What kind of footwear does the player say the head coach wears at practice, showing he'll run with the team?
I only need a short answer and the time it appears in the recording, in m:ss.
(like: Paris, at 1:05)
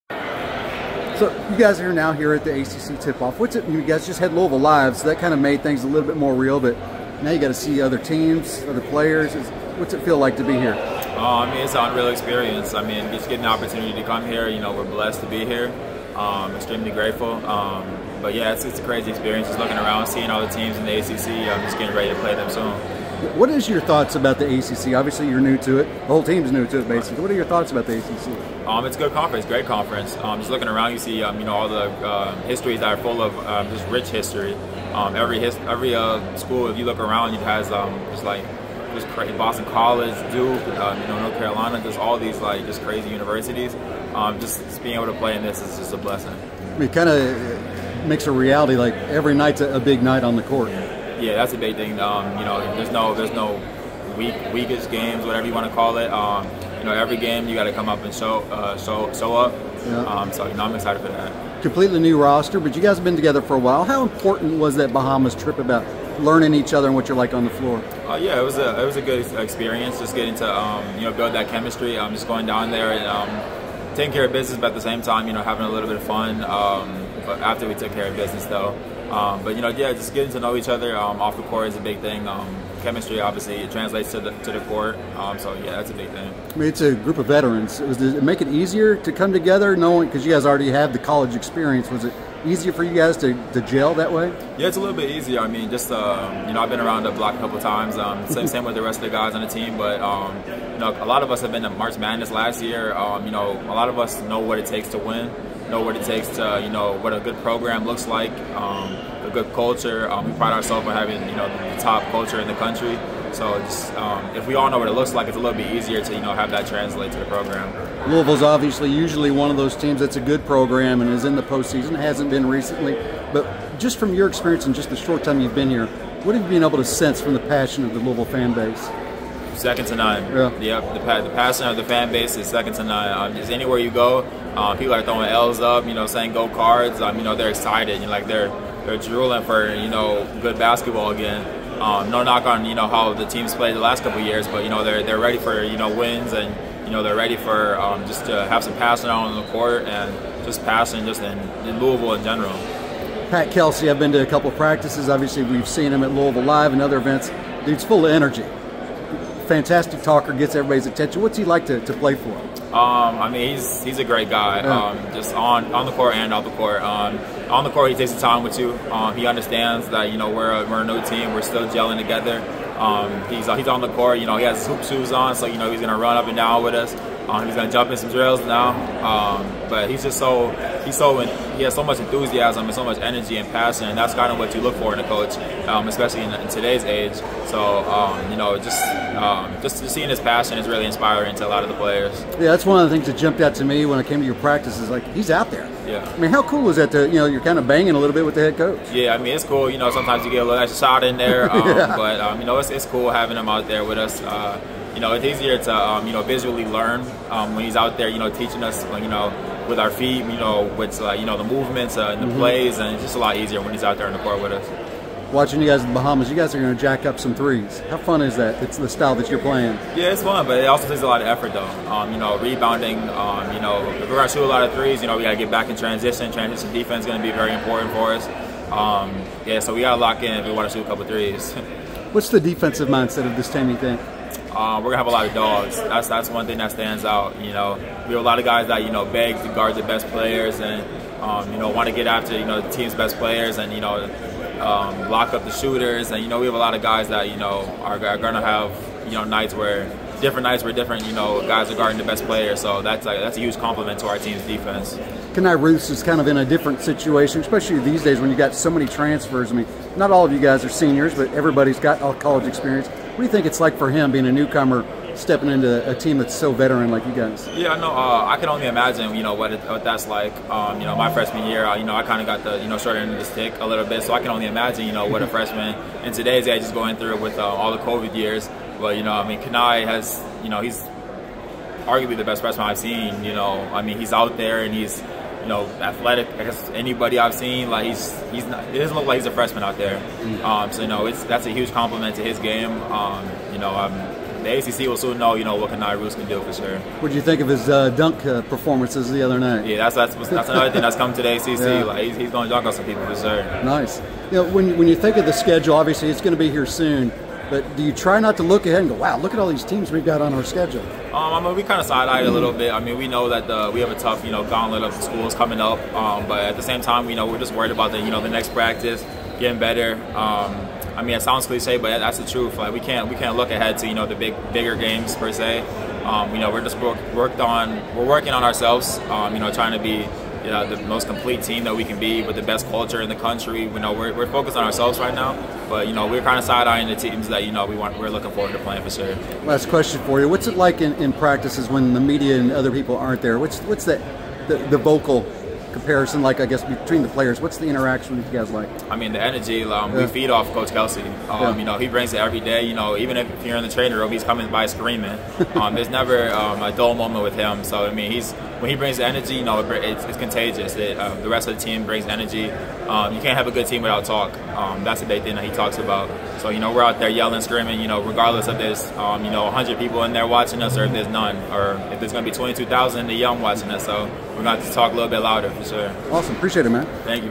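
hoop shoes, at 2:54.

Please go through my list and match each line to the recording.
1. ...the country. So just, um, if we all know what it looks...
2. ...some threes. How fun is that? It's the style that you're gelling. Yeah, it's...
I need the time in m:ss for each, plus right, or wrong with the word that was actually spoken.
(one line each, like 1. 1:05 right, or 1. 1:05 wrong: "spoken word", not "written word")
1. 1:52 right
2. 3:37 wrong: "playing", not "gelling".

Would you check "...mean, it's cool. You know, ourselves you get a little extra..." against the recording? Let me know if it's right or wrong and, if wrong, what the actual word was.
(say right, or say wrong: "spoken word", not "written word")
wrong: "sometimes", not "ourselves".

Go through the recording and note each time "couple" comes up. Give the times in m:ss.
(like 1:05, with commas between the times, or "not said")
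1:37, 2:24, 2:34, 3:50.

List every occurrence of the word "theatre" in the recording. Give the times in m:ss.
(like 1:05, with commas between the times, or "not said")
not said.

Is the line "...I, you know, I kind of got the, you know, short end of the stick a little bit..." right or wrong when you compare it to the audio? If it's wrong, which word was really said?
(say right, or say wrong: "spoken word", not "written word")
right.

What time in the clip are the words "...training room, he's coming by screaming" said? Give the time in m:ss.
5:53.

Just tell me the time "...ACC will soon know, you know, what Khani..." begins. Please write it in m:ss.
4:54.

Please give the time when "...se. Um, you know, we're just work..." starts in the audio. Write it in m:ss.
5:25.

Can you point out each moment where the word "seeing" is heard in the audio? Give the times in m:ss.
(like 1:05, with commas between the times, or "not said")
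0:20, 3:09.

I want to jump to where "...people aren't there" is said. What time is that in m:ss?
5:42.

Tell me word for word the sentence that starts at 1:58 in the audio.
Louisville's obviously usually one of those teams that's a good program and is in the postseason.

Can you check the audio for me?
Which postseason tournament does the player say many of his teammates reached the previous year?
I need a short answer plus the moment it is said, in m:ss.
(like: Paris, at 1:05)
March Madness, at 1:41.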